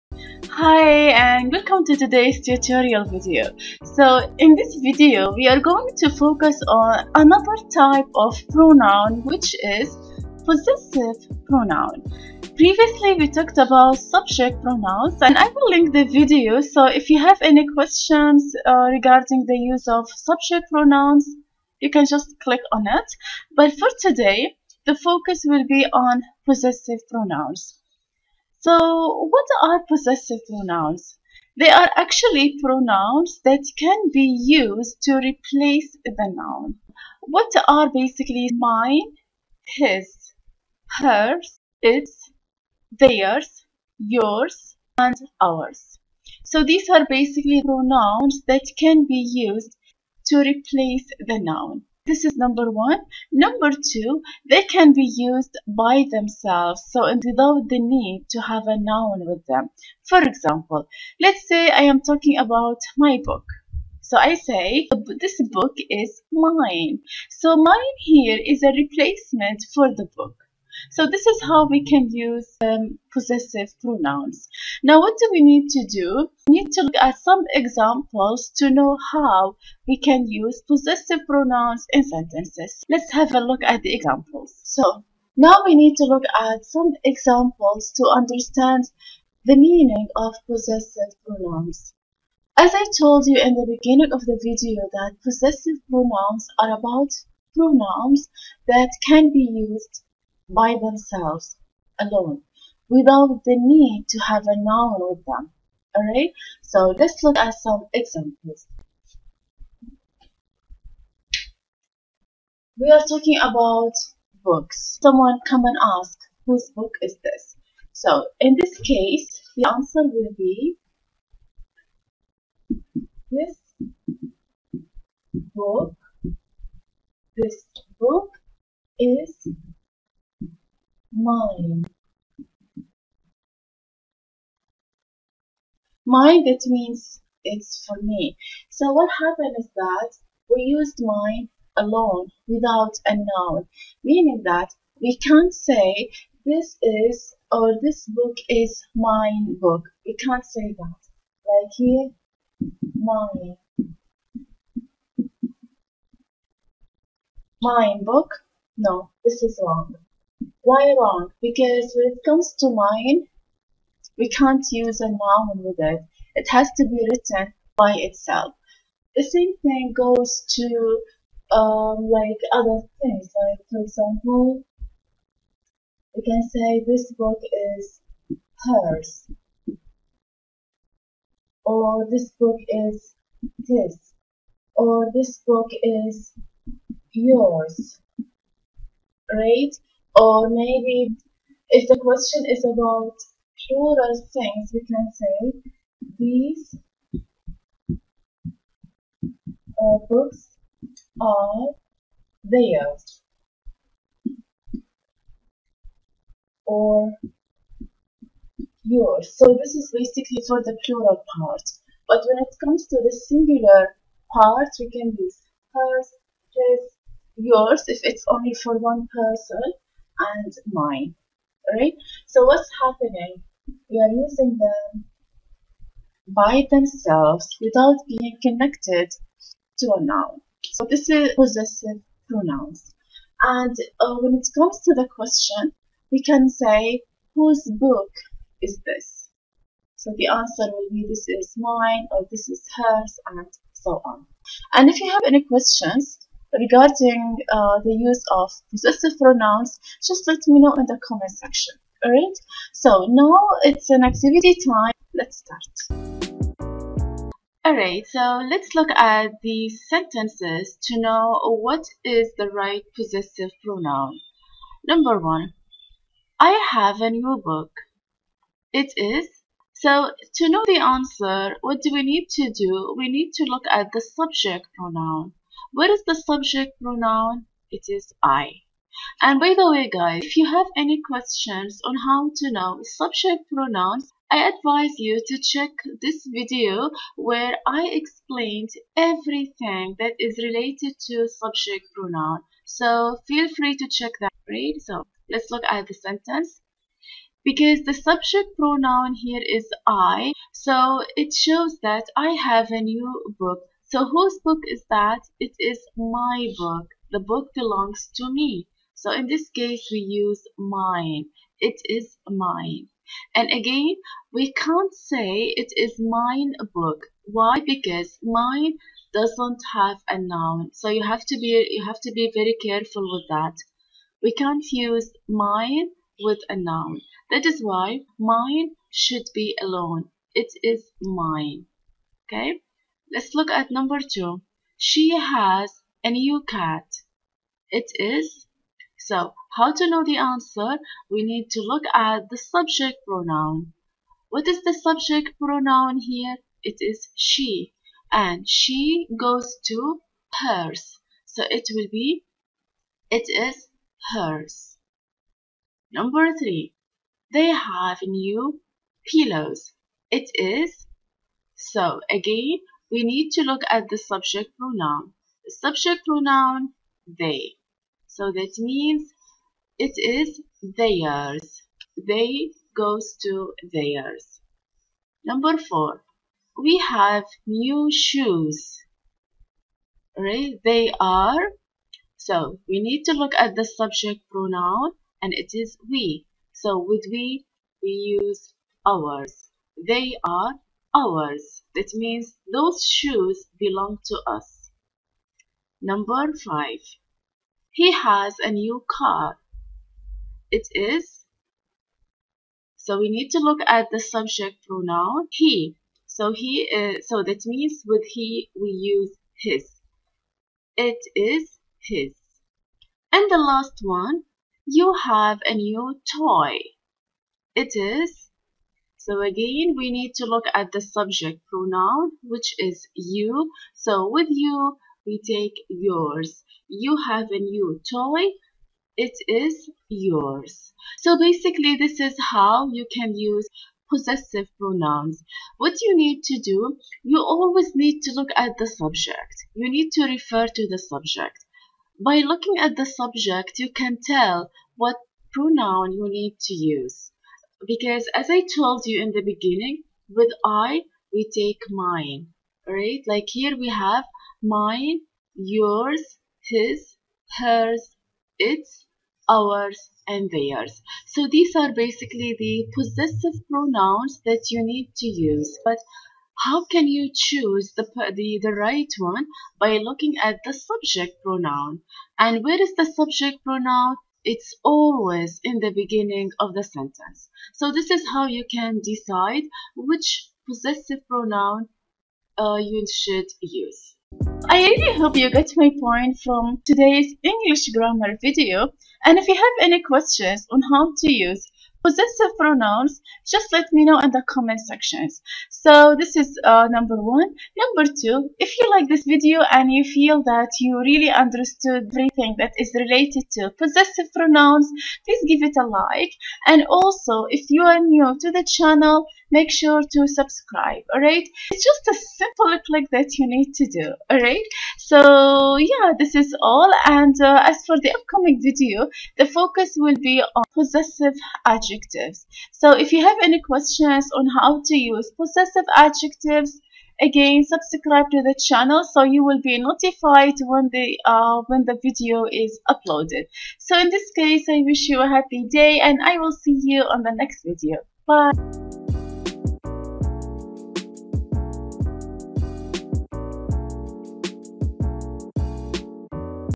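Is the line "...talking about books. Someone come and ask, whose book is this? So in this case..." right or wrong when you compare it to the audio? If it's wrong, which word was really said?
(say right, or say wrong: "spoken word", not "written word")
right.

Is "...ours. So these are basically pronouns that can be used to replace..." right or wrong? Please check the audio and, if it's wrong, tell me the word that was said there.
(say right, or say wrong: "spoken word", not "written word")
right.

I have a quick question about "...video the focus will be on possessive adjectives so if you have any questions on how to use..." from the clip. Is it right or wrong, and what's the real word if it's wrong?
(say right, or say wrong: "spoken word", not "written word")
right.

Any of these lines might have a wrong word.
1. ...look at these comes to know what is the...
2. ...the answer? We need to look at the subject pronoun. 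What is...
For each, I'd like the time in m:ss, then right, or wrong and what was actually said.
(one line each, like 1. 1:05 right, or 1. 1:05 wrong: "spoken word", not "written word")
1. 4:18 wrong: "sentences", not "comes"
2. 5:40 right.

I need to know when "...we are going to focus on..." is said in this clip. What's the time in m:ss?
0:05.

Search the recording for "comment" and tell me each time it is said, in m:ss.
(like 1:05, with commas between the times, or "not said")
4:11, 8:14.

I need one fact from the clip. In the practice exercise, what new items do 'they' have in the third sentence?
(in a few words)
pillows.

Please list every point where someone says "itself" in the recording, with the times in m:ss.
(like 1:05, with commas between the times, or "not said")
2:47.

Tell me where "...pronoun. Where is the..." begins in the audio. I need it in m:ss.
4:34.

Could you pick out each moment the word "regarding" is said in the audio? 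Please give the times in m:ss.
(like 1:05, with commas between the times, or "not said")
0:18, 4:06.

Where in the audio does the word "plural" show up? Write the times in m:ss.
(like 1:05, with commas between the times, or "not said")
3:13, 3:30.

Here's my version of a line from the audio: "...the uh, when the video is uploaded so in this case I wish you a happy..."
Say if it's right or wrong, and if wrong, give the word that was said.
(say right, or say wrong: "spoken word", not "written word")
right.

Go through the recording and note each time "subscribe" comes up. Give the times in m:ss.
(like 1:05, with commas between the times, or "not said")
8:30, 8:47.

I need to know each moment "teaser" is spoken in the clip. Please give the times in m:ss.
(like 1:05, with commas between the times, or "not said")
not said.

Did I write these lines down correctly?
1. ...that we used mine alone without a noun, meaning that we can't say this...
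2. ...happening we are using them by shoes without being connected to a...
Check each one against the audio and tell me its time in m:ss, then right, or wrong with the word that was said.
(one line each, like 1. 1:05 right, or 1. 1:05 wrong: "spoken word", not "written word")
1. 2:19 right
2. 3:42 wrong: "themselves", not "shoes".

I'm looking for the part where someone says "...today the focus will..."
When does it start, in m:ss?
0:23.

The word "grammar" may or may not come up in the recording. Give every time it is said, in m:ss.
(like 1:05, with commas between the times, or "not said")
8:07.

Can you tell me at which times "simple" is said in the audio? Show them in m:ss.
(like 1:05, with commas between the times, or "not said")
8:32.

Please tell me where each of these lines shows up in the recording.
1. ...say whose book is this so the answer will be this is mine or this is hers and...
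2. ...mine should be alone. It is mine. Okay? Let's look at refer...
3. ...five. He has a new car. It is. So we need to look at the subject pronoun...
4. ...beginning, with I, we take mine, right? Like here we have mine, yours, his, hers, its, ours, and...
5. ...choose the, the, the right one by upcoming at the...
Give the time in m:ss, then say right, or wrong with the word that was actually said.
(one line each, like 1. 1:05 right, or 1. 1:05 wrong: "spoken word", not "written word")
1. 3:56 right
2. 5:28 wrong: "number", not "refer"
3. 6:36 right
4. 7:29 right
5. 7:47 wrong: "looking", not "upcoming".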